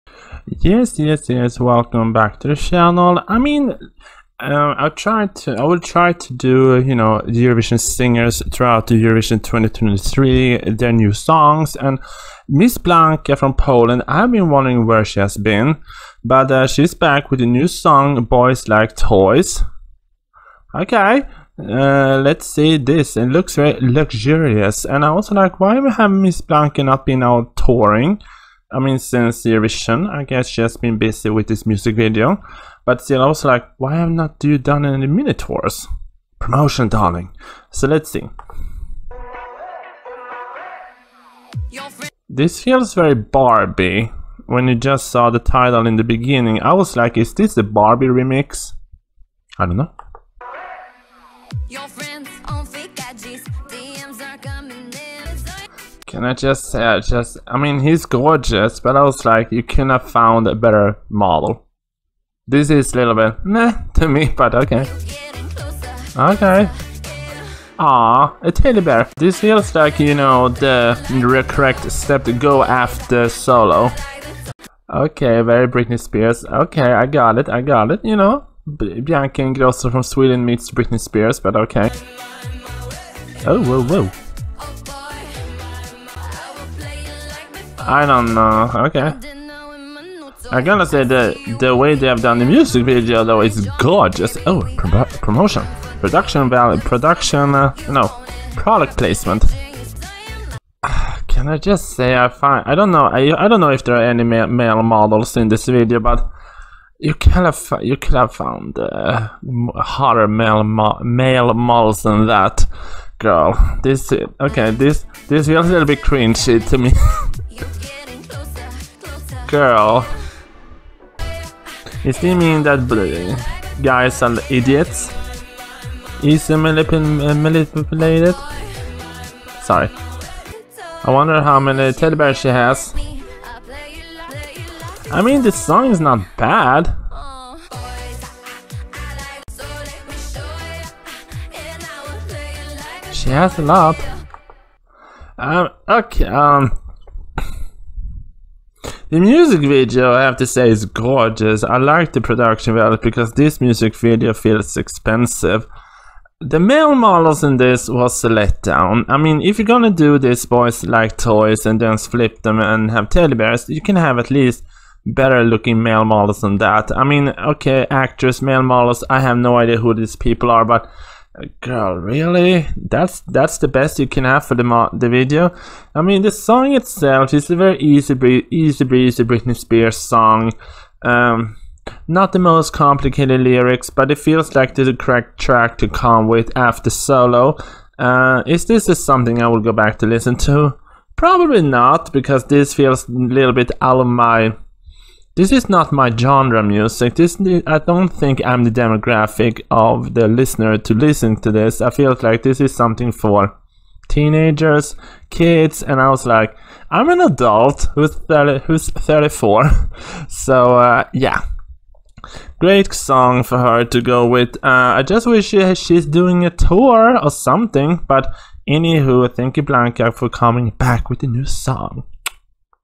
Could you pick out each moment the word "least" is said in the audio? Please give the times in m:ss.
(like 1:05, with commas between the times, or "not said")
2:44.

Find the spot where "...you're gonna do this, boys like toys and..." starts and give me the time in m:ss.
2:39.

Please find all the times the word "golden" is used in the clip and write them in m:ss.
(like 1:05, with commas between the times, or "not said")
not said.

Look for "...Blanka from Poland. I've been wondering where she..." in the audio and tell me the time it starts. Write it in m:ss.
0:12.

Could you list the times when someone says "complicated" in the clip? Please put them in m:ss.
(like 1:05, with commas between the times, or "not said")
3:02.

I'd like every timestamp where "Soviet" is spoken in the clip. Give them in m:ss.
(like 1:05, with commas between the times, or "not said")
not said.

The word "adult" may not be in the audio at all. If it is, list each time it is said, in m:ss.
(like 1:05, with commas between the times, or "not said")
3:27.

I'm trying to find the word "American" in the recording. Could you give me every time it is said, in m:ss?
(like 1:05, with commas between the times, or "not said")
not said.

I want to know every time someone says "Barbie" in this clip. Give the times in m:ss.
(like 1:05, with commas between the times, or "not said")
0:43, 0:47.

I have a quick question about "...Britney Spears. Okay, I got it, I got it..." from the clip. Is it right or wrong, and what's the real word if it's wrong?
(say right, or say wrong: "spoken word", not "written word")
right.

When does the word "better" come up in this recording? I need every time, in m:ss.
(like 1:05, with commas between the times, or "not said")
1:00, 2:45.